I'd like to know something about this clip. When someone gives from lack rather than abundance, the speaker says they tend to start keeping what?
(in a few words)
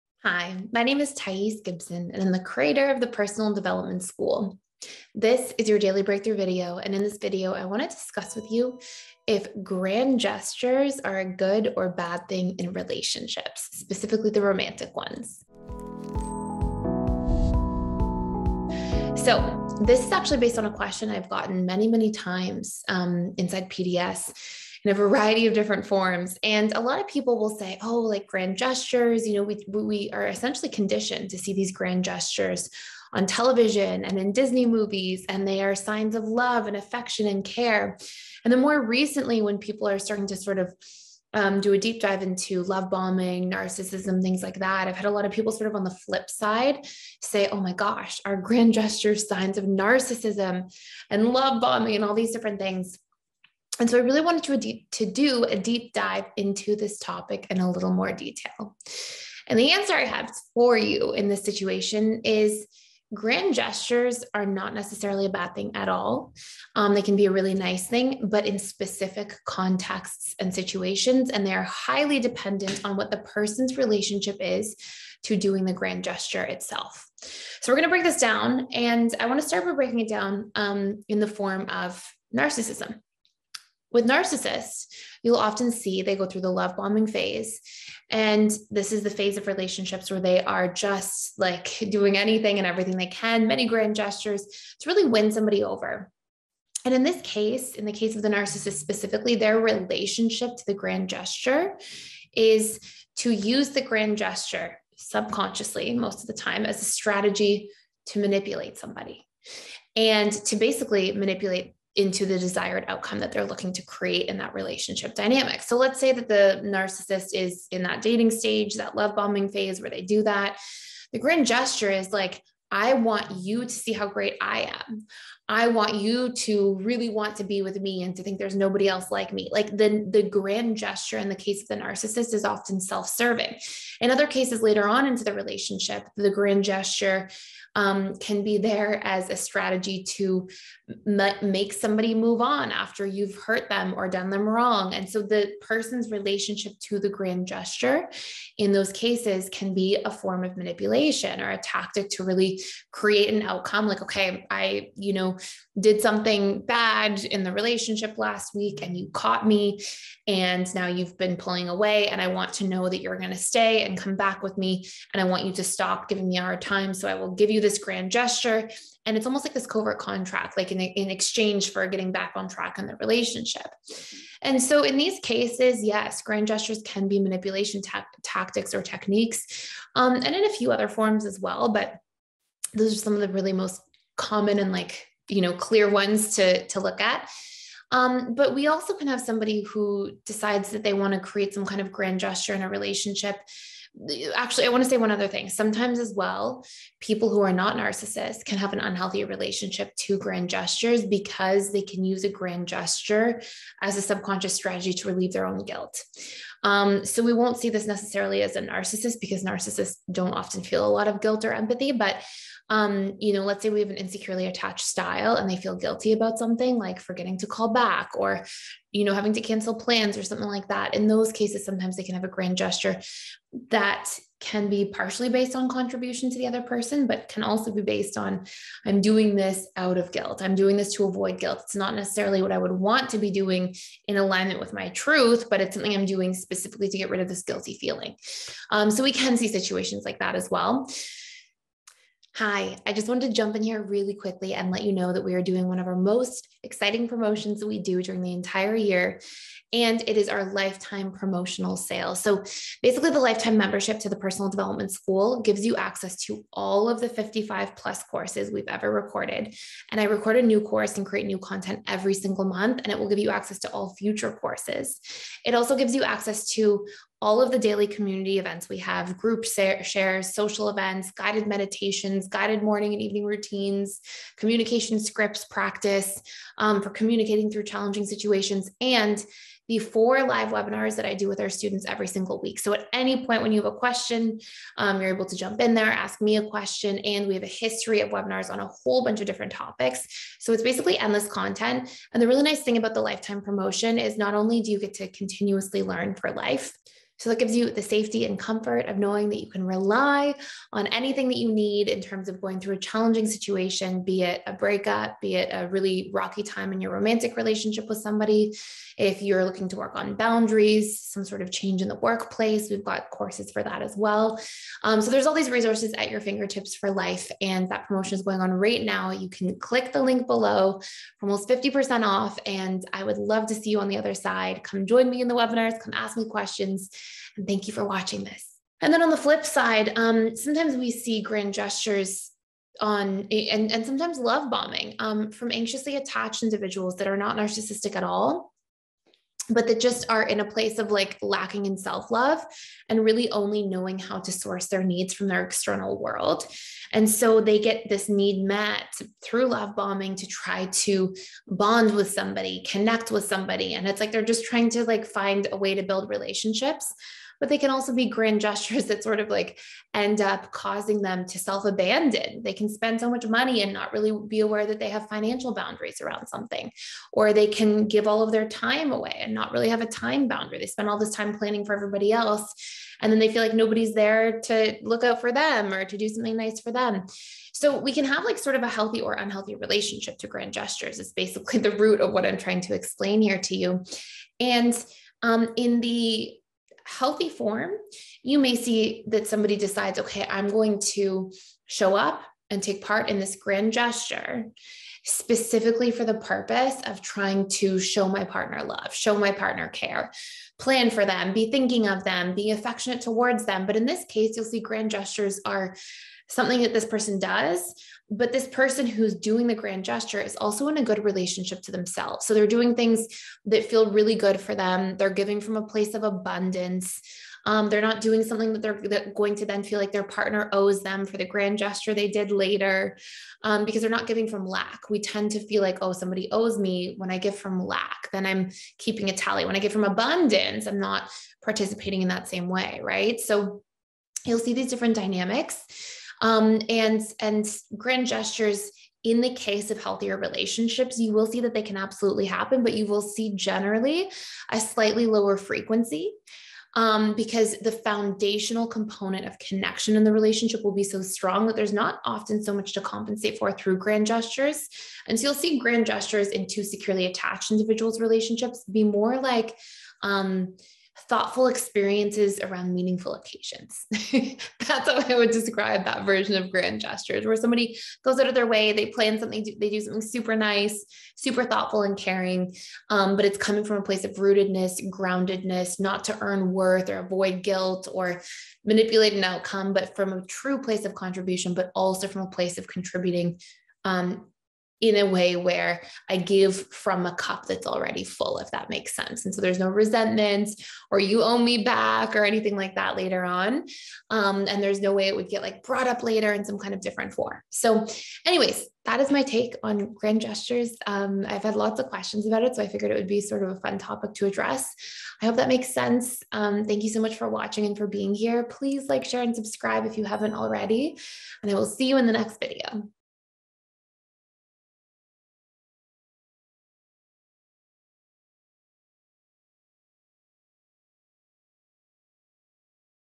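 a tally.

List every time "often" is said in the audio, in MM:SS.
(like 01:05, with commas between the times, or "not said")
01:25, 02:12, 03:30, 07:32.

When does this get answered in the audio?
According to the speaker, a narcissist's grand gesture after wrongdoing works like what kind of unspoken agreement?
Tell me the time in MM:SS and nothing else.
02:49.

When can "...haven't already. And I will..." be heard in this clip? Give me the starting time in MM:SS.
08:30.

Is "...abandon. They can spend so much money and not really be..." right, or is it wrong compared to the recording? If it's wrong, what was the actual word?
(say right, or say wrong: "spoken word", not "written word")
right.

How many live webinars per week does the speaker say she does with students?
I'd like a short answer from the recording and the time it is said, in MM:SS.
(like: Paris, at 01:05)
4, at 04:39.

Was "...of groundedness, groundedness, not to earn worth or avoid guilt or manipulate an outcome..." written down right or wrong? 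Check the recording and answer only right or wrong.
wrong.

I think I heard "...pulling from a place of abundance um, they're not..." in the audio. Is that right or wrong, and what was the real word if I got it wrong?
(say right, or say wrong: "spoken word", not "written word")
wrong: "giving", not "pulling".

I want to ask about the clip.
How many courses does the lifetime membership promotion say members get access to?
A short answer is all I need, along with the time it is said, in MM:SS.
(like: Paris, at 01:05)
55 plus, at 04:17.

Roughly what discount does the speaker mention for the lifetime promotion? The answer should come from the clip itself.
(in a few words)
almost 50% off.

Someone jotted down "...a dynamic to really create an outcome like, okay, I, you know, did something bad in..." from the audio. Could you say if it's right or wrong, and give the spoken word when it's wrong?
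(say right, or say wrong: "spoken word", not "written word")
wrong: "tactic", not "dynamic".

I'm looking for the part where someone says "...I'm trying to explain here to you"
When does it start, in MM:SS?
06:22.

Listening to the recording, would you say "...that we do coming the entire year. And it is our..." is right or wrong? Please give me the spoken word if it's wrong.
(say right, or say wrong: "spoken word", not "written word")
wrong: "during", not "coming".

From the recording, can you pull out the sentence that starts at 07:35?
And so you'll see grand gestures in two securely attached individuals' relationships be more like, um, thoughtful experiences around meaningful occasions.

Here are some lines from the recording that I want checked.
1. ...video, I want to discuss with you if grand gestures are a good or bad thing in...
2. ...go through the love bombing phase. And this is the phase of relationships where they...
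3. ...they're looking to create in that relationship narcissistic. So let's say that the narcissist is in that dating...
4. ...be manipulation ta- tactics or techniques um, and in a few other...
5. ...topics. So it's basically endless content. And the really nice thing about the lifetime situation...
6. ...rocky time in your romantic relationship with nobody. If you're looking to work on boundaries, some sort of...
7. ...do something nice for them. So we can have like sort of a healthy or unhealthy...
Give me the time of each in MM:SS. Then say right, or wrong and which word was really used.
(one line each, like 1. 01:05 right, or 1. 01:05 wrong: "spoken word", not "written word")
1. 00:07 right
2. 01:26 right
3. 01:53 wrong: "dynamic", not "narcissistic"
4. 02:57 right
5. 04:49 wrong: "promotion", not "situation"
6. 05:06 wrong: "somebody", not "nobody"
7. 06:15 right.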